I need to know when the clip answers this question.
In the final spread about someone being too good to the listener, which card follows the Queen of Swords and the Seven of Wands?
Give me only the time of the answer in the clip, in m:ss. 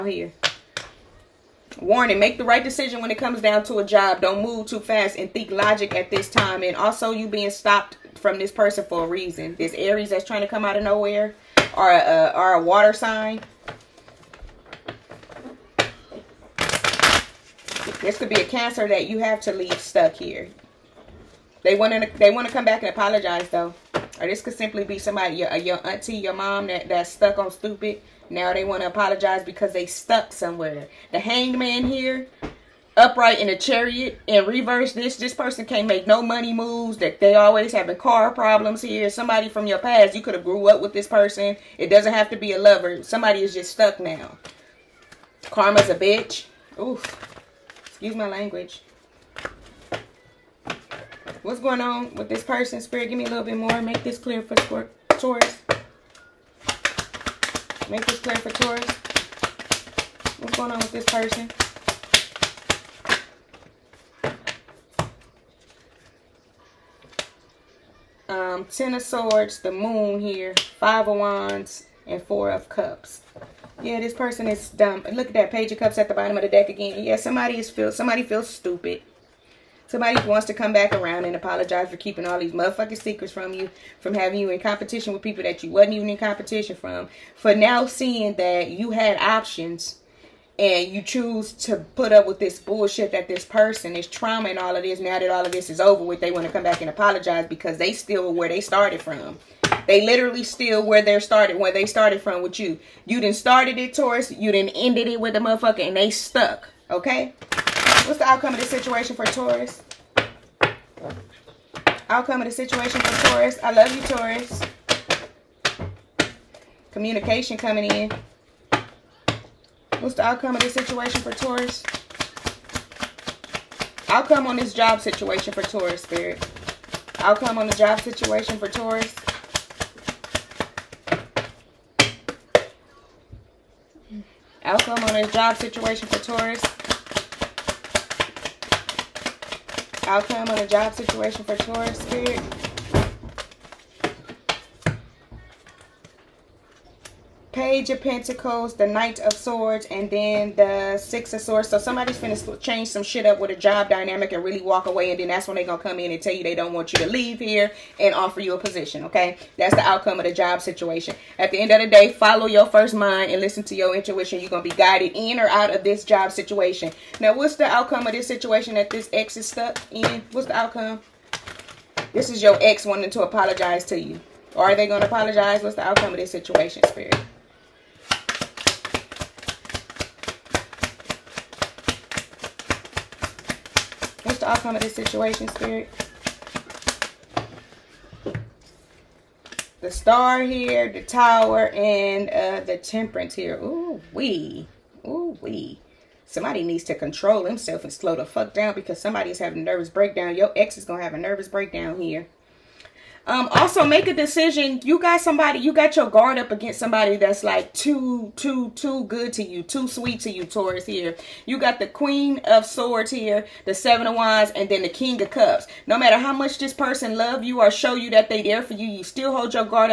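3:34.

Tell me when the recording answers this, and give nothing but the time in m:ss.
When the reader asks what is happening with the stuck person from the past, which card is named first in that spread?
1:08.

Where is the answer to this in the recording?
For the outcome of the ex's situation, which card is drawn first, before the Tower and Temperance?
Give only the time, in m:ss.
3:09.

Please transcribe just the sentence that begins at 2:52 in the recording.
This is your ex wanting to apologize to you.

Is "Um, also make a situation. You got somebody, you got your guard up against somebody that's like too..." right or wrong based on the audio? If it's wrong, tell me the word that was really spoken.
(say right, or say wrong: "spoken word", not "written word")
wrong: "decision", not "situation".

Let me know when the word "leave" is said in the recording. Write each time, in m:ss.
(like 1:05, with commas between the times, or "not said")
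0:19, 2:37.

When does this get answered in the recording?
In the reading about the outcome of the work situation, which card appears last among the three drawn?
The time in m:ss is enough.
2:30.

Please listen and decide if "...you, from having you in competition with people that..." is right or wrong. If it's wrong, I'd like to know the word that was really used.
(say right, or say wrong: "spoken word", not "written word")
right.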